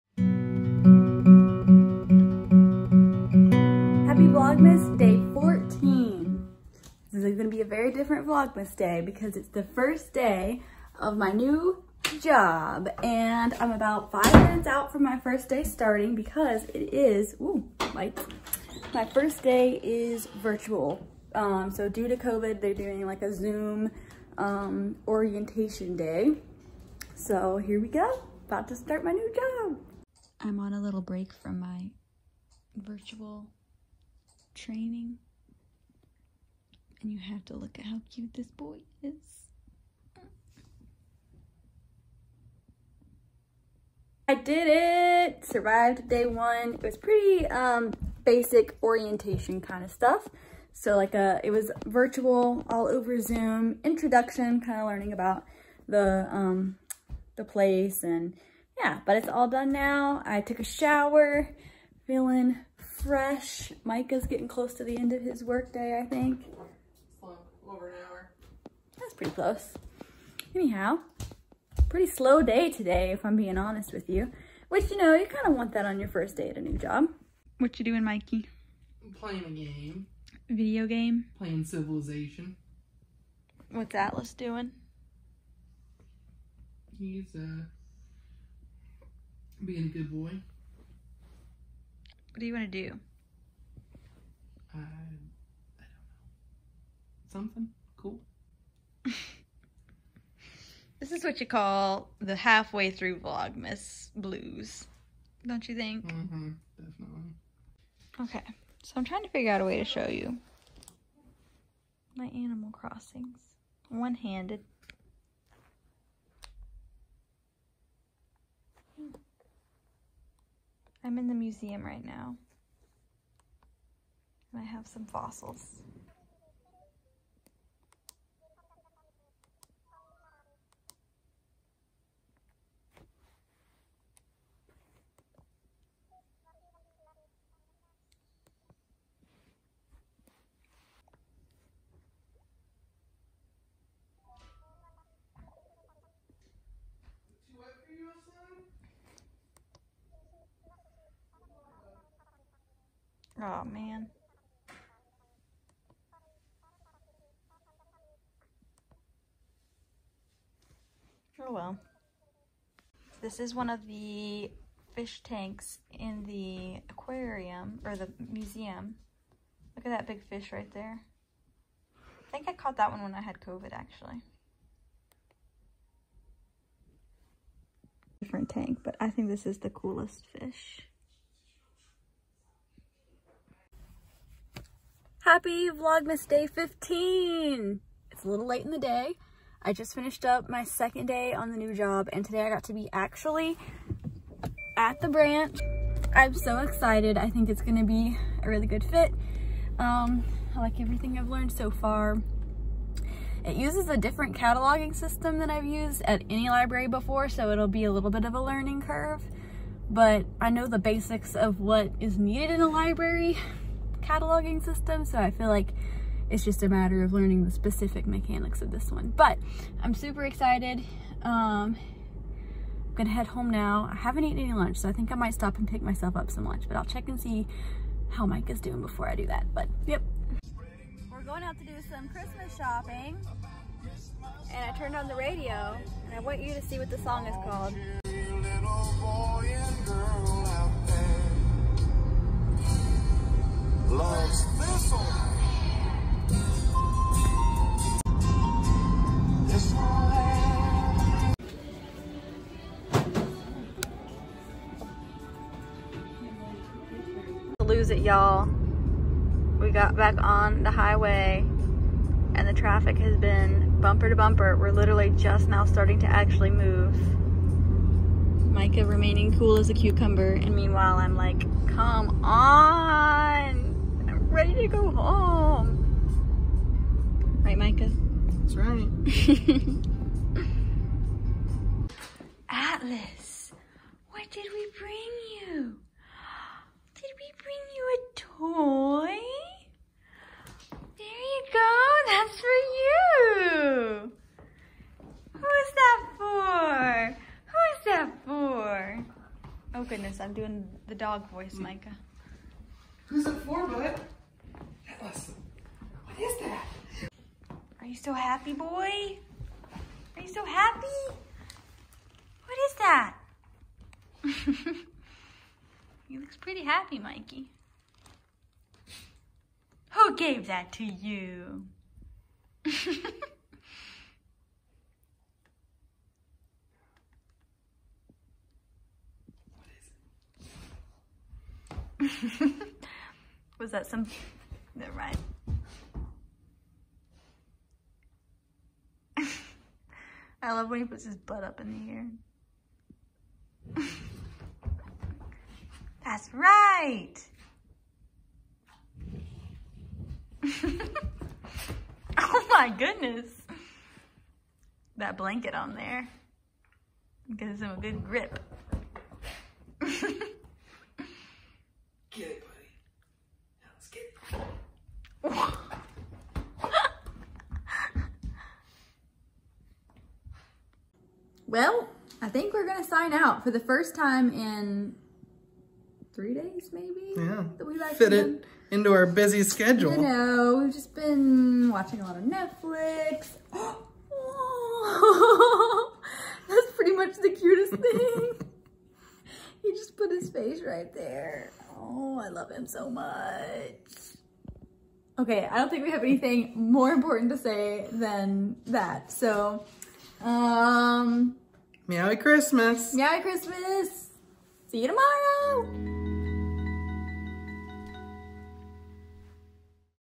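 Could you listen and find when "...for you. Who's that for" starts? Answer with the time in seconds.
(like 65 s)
292 s.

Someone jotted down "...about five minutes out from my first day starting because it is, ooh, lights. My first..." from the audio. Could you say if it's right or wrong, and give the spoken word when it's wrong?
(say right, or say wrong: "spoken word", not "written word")
right.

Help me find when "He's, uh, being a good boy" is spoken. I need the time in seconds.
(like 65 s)
86 s.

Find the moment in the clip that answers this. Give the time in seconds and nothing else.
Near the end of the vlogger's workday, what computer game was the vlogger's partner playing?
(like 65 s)
81 s.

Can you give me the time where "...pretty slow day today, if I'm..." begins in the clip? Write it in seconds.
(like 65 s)
71 s.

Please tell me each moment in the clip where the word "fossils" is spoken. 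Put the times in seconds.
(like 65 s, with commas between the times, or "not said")
125 s.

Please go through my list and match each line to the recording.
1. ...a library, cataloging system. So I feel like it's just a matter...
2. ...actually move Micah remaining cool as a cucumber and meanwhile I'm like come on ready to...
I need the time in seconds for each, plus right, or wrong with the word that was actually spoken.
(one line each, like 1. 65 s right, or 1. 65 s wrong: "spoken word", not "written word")
1. 212 s right
2. 266 s right.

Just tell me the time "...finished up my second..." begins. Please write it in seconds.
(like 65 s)
189 s.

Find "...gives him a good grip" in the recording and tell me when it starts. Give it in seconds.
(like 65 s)
357 s.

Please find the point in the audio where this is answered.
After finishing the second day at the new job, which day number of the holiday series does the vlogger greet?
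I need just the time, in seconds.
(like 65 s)
186 s.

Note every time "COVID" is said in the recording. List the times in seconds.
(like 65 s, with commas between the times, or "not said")
22 s, 173 s.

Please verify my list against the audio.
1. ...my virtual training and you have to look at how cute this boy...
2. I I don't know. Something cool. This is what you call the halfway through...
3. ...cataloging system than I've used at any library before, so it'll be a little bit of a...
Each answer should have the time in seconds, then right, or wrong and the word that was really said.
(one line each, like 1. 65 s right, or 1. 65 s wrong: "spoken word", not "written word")
1. 31 s right
2. 94 s right
3. 204 s right.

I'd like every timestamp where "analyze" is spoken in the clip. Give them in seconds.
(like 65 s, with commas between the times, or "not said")
not said.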